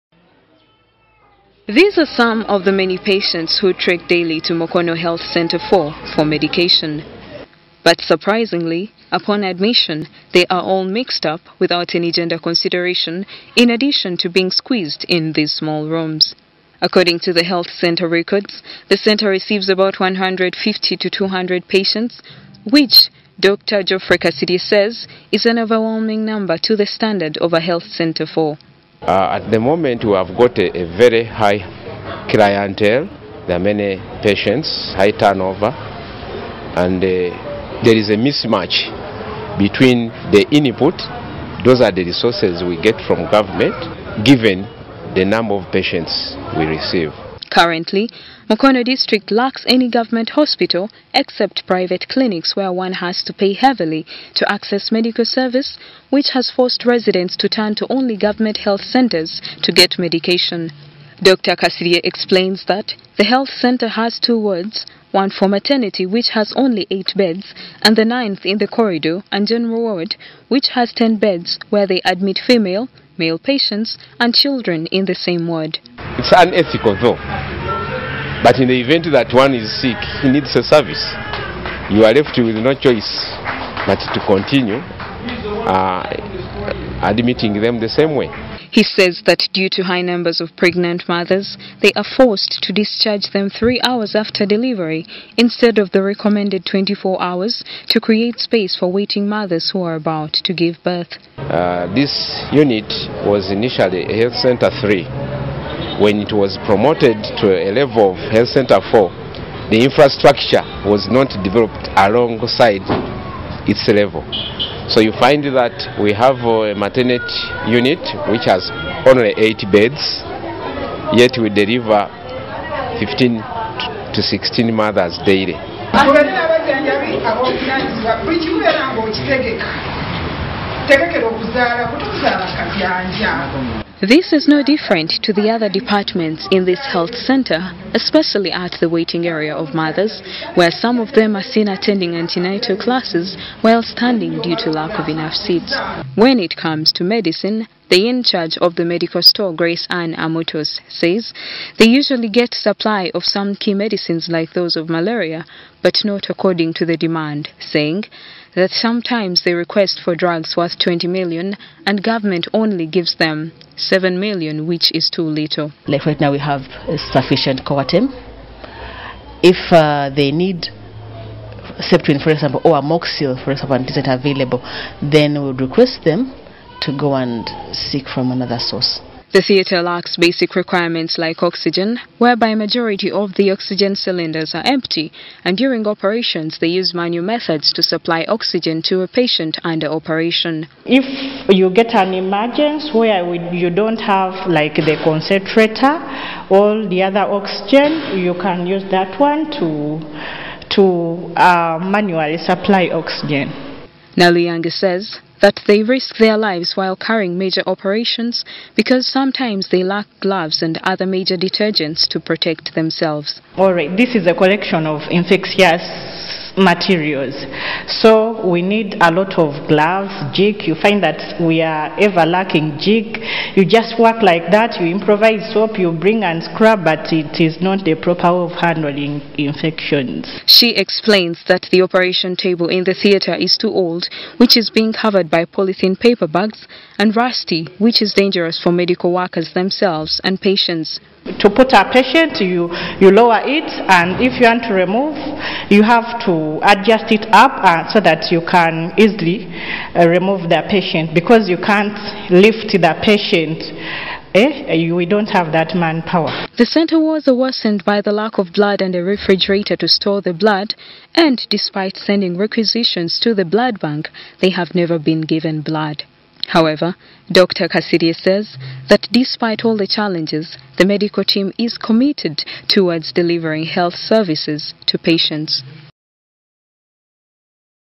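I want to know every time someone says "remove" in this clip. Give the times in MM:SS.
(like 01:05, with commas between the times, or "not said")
04:04, 04:10.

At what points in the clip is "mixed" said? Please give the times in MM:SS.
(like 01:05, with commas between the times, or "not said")
00:10.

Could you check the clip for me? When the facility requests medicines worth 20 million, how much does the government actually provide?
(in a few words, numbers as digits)
7 million.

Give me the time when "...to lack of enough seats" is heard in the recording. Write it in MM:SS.
02:24.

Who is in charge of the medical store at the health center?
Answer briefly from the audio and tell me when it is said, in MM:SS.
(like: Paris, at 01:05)
Grace Ann Amotos, at 02:29.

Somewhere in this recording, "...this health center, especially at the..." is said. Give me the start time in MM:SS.
02:16.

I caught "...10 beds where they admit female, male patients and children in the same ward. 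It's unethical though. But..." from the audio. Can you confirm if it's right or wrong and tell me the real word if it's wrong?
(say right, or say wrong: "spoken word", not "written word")
right.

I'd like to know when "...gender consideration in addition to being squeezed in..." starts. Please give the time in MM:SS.
00:12.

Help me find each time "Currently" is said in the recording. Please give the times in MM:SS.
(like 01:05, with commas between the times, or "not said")
00:47.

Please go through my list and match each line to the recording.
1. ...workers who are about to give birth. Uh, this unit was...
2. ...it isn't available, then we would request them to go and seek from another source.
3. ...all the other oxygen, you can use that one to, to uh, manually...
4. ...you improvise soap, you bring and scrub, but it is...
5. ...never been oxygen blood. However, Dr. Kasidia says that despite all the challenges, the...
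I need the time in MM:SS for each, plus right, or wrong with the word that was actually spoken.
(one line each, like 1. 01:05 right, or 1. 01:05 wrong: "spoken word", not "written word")
1. 01:39 wrong: "mothers", not "workers"
2. 02:53 right
3. 03:16 right
4. 03:44 right
5. 04:24 wrong: "given", not "oxygen".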